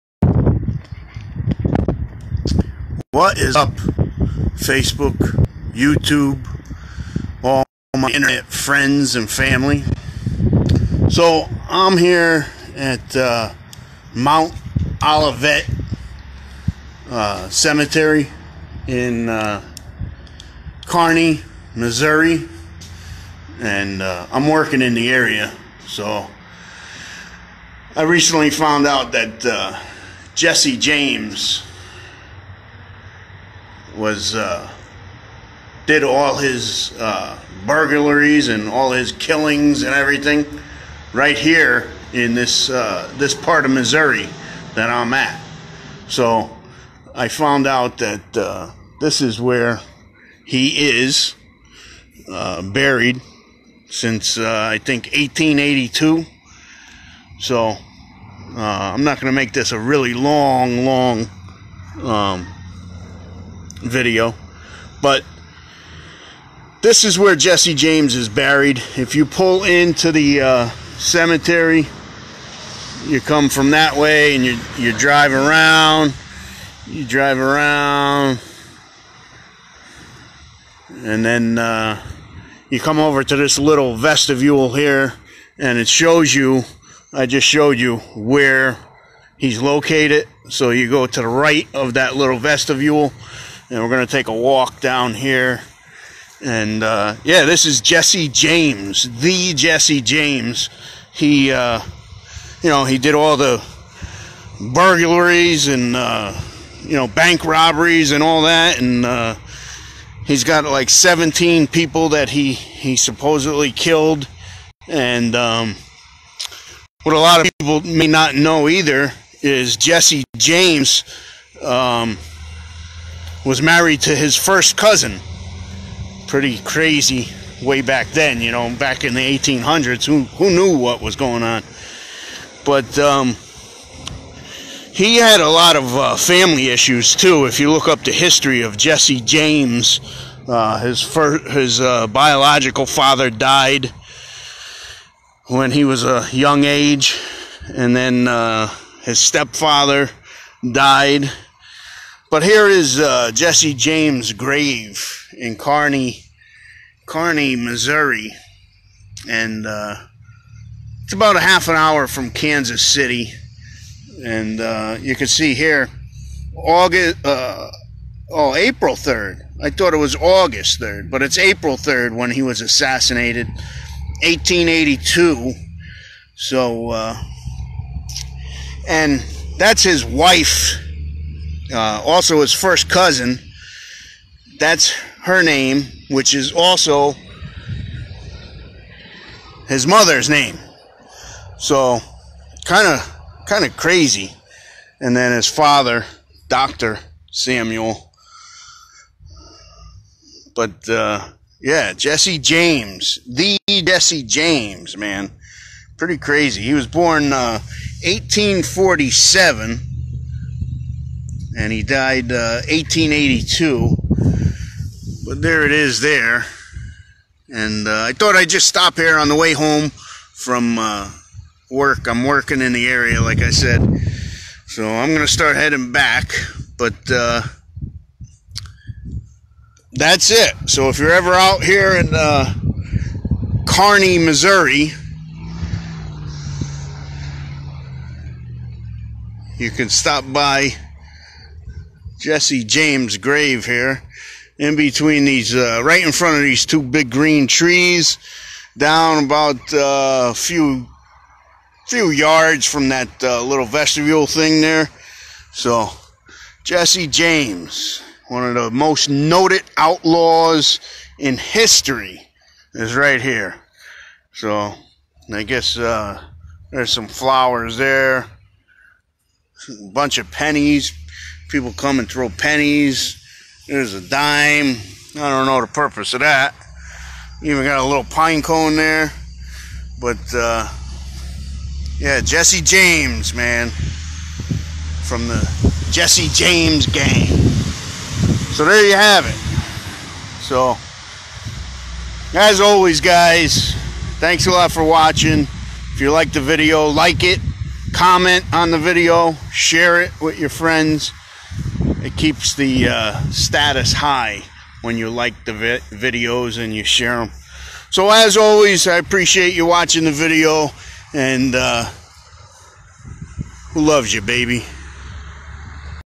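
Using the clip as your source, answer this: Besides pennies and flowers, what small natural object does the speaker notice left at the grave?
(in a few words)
pine cone.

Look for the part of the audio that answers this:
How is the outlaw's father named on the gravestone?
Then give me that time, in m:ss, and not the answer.
3:16.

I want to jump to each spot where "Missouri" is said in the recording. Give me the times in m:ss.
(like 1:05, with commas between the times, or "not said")
0:21, 0:43, 2:37, 3:54.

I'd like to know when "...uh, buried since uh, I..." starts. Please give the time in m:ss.
0:52.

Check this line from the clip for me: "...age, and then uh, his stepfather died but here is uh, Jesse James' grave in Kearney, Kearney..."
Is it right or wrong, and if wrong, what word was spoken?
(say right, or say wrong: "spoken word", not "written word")
right.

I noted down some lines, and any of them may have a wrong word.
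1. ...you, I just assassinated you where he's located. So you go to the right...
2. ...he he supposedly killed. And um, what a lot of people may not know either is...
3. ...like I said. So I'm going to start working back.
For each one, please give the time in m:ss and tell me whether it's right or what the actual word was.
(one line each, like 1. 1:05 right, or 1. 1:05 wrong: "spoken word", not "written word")
1. 1:26 wrong: "showed", not "assassinated"
2. 1:52 right
3. 3:43 wrong: "heading", not "working".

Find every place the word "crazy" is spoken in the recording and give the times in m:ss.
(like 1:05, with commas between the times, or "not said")
2:06, 3:13, 3:26.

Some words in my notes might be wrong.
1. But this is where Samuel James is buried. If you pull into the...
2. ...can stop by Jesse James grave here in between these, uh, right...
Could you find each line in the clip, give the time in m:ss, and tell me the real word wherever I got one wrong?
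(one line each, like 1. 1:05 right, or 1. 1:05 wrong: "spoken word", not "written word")
1. 1:05 wrong: "Jesse", not "Samuel"
2. 3:59 right.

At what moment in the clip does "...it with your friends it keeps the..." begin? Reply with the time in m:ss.
5:00.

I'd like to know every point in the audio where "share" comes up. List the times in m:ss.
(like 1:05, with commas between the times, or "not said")
4:59, 5:06.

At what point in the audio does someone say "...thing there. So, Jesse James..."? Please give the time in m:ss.
4:14.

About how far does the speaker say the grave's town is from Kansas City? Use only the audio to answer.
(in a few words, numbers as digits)
half an hour.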